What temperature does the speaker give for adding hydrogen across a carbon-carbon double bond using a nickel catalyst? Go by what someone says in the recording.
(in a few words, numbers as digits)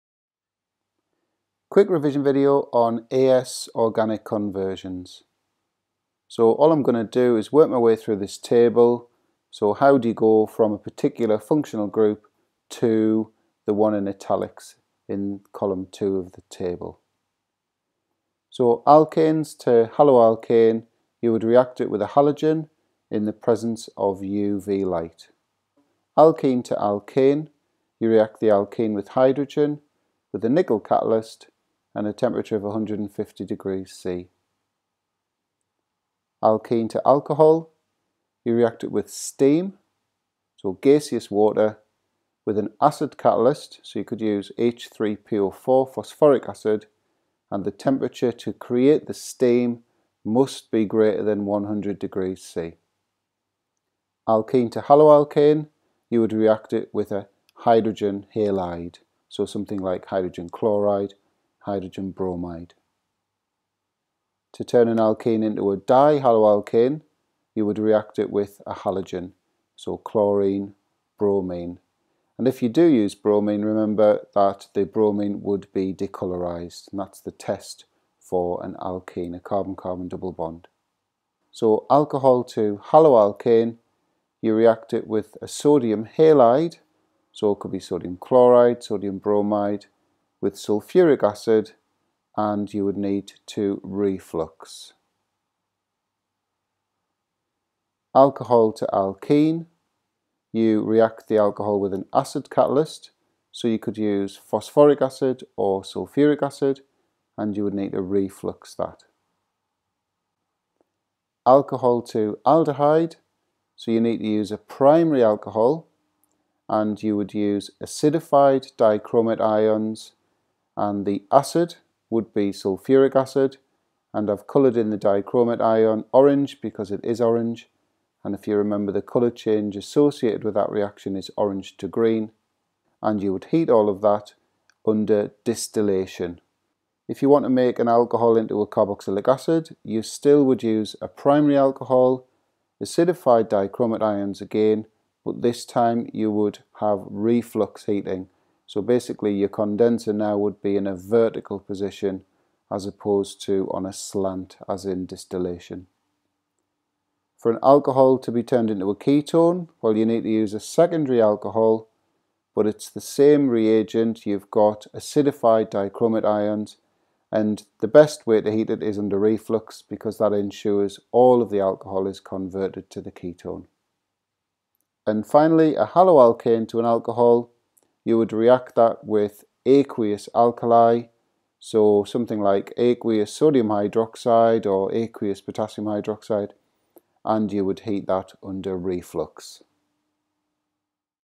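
150 degrees C.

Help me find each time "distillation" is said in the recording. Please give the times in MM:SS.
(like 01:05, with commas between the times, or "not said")
02:15, 02:35.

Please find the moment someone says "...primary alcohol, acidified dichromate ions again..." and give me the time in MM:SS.
02:21.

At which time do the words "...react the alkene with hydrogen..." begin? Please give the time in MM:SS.
00:28.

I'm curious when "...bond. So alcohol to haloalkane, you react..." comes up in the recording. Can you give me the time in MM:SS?
01:20.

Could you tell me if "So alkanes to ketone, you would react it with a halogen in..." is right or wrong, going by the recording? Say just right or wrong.
wrong.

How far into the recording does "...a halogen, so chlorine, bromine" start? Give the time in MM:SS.
01:08.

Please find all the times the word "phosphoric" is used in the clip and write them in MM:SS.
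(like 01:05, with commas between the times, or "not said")
00:45, 01:44.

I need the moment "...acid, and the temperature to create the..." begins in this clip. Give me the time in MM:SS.
00:46.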